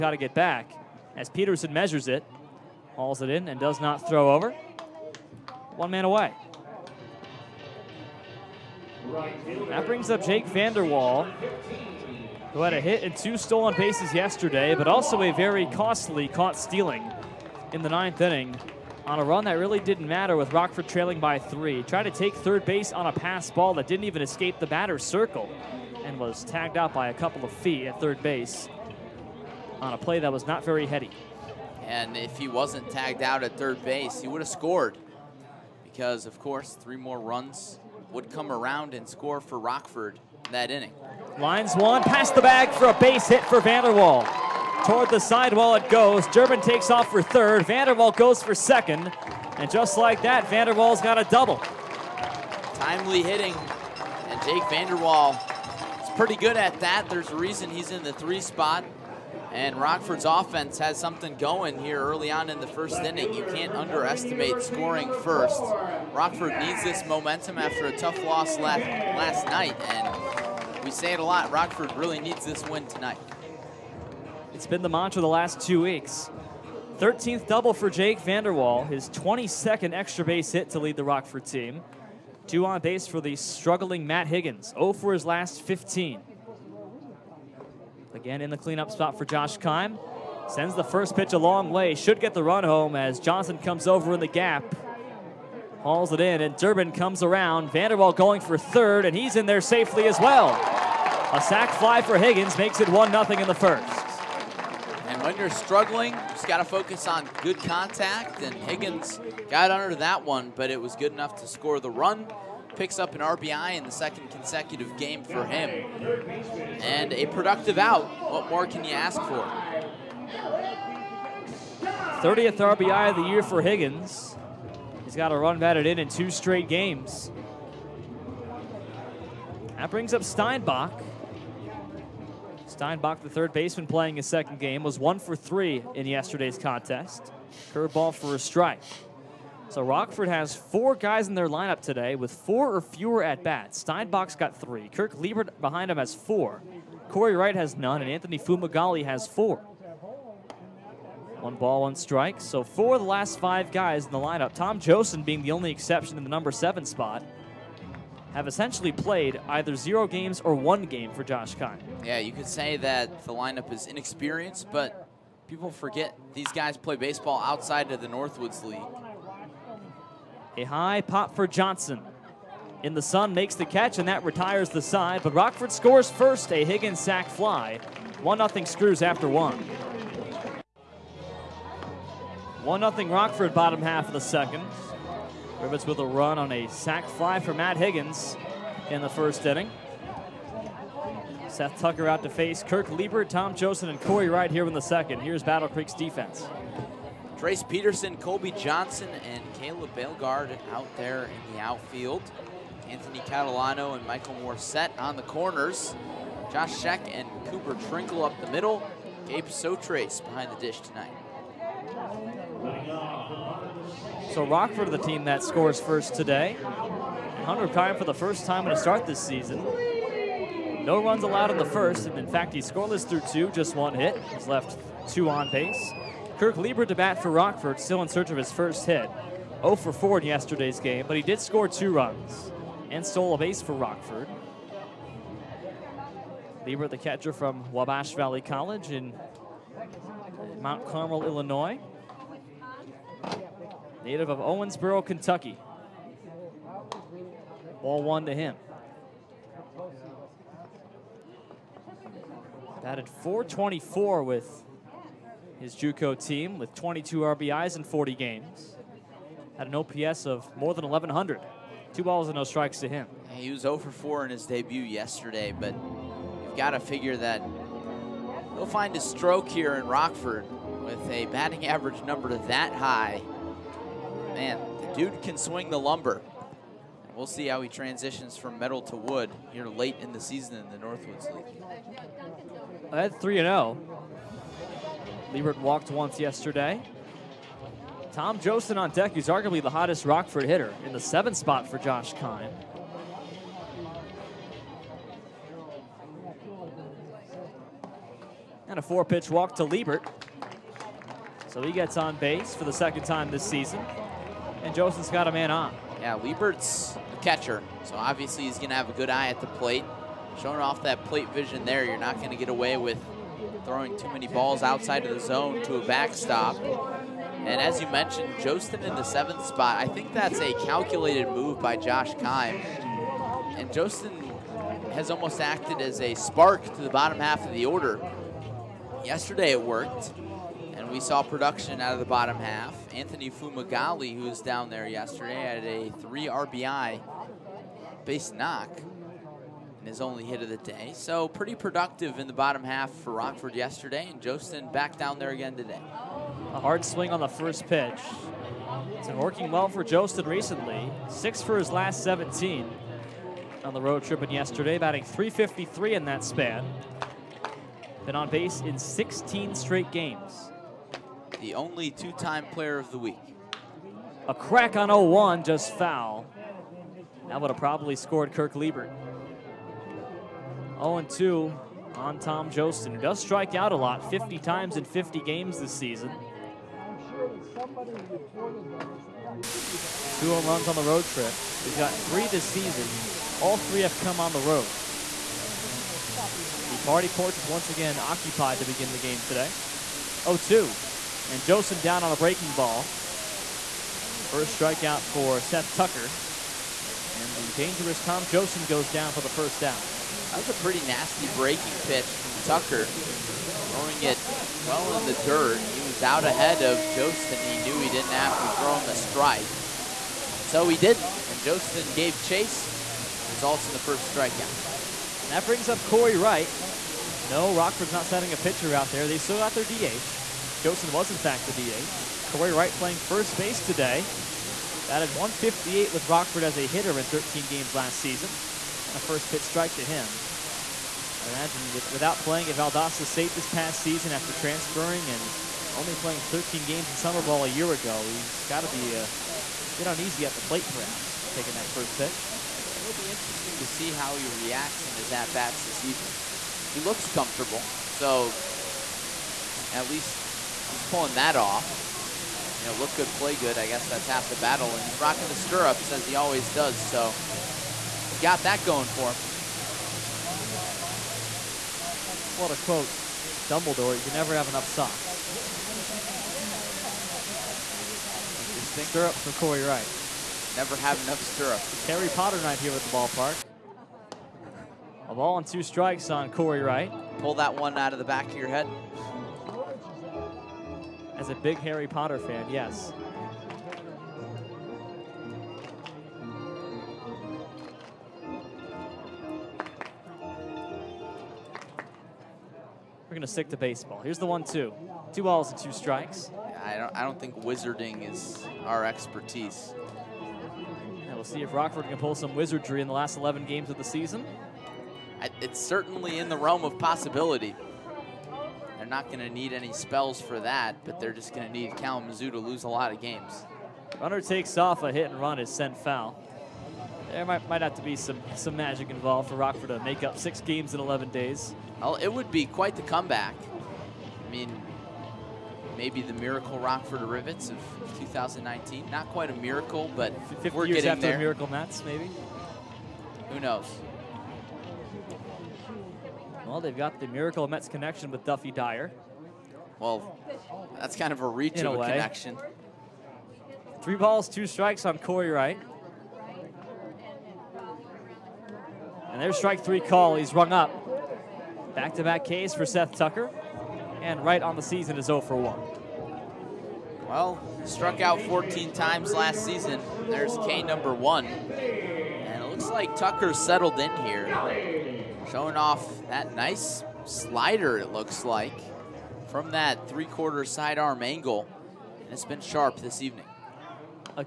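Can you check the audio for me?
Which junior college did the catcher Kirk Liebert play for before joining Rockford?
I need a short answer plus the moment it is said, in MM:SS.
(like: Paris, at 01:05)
Wabash Valley College, at 03:57.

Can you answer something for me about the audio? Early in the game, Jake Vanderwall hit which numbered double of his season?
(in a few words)
13th.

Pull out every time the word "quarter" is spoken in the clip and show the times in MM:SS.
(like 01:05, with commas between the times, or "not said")
09:30.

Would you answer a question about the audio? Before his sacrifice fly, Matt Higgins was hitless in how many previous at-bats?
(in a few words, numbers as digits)
15.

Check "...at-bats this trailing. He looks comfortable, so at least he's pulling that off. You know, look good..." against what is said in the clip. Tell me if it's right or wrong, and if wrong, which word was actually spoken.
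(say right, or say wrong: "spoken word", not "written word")
wrong: "evening", not "trailing".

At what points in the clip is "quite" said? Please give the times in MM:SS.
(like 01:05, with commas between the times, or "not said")
08:42, 08:49.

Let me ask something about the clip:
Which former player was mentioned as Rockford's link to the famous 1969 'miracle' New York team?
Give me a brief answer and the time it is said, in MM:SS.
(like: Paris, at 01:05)
Duffy Dyer, at 08:58.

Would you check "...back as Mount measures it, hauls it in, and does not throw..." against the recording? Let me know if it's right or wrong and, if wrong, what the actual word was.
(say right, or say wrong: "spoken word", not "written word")
wrong: "Peterson", not "Mount".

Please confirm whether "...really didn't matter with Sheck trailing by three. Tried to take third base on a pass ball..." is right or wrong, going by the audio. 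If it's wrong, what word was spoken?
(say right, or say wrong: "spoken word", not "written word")
wrong: "Rockford", not "Sheck".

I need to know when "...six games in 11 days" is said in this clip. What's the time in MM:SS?
08:40.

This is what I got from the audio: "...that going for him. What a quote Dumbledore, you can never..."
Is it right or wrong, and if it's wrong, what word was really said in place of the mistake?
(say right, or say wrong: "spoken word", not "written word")
right.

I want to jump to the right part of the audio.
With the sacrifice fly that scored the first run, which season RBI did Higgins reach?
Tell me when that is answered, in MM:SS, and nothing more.
02:02.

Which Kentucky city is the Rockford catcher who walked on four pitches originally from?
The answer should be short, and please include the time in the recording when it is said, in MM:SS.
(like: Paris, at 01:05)
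Owensboro, at 04:04.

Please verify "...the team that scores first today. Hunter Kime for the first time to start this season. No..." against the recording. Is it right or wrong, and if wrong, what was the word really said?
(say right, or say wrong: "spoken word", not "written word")
right.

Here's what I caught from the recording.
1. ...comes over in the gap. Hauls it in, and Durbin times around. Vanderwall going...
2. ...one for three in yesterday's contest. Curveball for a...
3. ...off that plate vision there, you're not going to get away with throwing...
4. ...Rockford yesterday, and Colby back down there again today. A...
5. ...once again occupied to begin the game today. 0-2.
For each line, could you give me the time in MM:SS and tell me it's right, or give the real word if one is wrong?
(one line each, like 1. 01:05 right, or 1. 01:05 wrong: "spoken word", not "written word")
1. 01:33 wrong: "comes", not "times"
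2. 02:14 right
3. 05:10 right
4. 05:43 wrong: "Jostin", not "Colby"
5. 06:27 right.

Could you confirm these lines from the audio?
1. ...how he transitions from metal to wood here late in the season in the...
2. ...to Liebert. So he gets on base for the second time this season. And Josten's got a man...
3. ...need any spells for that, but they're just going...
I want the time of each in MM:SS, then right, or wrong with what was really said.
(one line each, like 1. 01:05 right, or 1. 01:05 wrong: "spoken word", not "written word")
1. 04:37 right
2. 04:59 right
3. 08:29 right.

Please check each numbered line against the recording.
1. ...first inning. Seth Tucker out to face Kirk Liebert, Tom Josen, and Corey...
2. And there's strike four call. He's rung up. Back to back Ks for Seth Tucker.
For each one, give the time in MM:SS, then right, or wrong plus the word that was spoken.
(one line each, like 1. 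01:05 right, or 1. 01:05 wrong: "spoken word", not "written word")
1. 03:09 right
2. 09:09 wrong: "three", not "four".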